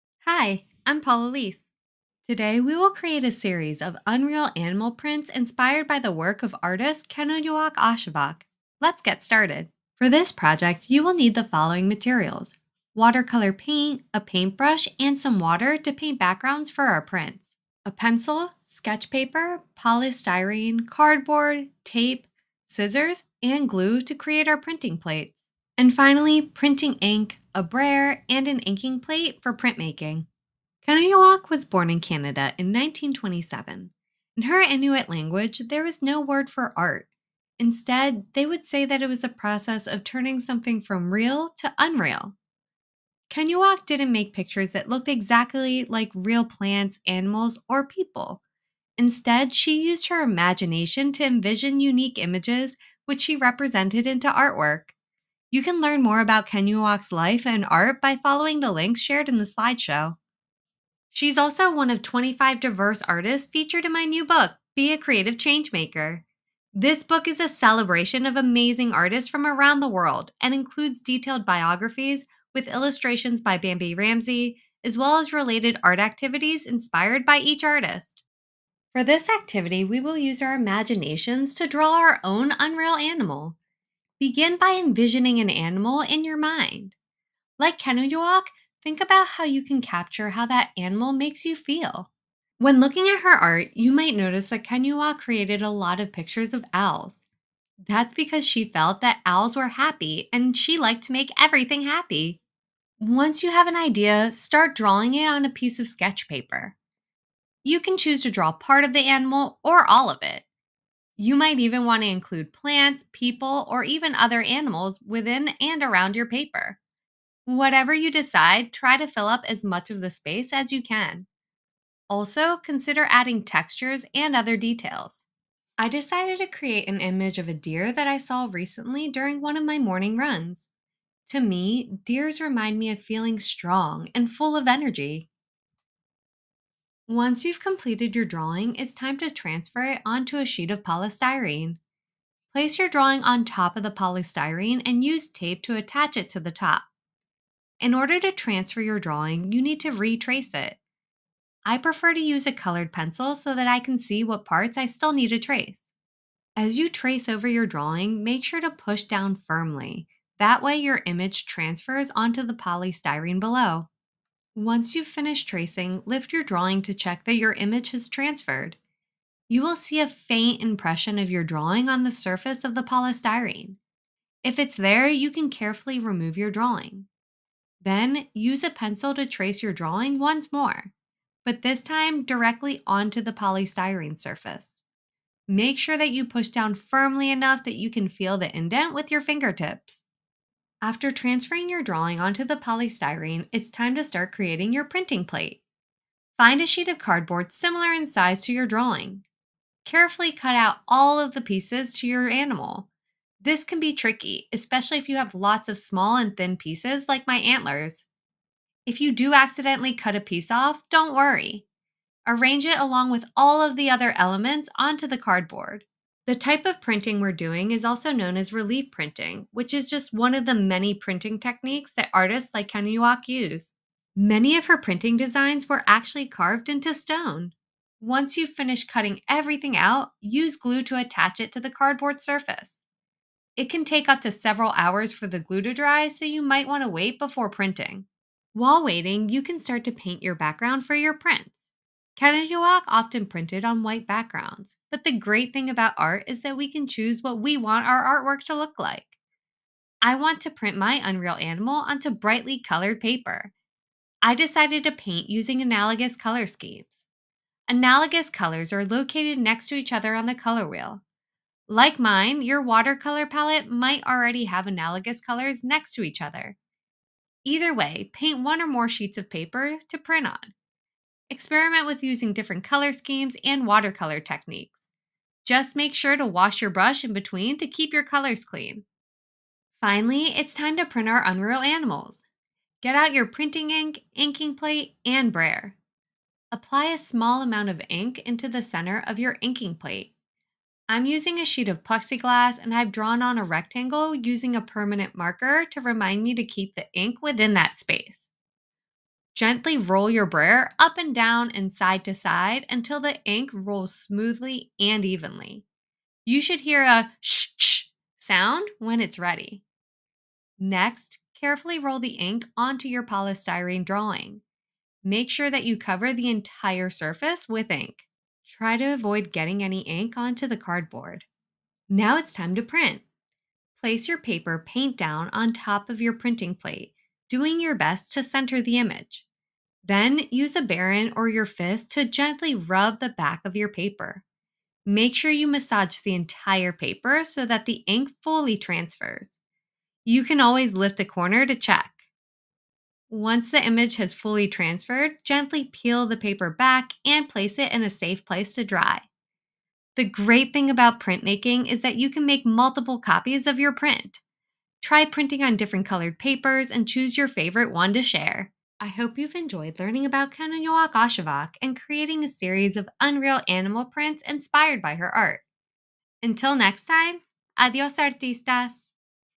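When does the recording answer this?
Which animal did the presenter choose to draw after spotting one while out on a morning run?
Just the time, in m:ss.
2:07.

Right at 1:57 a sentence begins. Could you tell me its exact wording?
Whatever you decide, try to fill up as much of the space as you can.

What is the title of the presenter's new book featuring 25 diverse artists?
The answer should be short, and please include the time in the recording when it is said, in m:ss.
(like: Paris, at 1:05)
Be a Creative Changemaker, at 1:04.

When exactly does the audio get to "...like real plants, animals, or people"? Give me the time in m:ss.
0:45.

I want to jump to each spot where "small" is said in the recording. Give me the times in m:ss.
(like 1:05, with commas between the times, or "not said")
3:25, 4:46.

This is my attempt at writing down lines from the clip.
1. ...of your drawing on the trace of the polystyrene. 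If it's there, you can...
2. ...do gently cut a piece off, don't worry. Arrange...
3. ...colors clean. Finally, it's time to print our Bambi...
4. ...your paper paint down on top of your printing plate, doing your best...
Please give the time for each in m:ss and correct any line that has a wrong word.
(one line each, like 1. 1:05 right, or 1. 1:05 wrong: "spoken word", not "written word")
1. 2:51 wrong: "surface", not "trace"
2. 3:29 wrong: "accidentally", not "gently"
3. 4:38 wrong: "Unreal", not "Bambi"
4. 5:24 right.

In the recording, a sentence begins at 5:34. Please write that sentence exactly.
Make sure you massage the entire paper so that the ink fully transfers.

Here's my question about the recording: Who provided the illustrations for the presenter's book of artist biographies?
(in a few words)
Bambi Ramsey.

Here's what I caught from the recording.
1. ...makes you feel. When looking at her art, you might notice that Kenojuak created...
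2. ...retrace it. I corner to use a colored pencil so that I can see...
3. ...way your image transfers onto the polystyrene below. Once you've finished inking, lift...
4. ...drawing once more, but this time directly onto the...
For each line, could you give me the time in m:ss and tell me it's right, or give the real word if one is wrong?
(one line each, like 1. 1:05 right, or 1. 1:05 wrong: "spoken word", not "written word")
1. 1:31 right
2. 2:29 wrong: "prefer", not "corner"
3. 2:40 wrong: "tracing", not "inking"
4. 2:59 right.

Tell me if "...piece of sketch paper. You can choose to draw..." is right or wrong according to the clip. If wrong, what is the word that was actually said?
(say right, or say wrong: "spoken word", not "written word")
right.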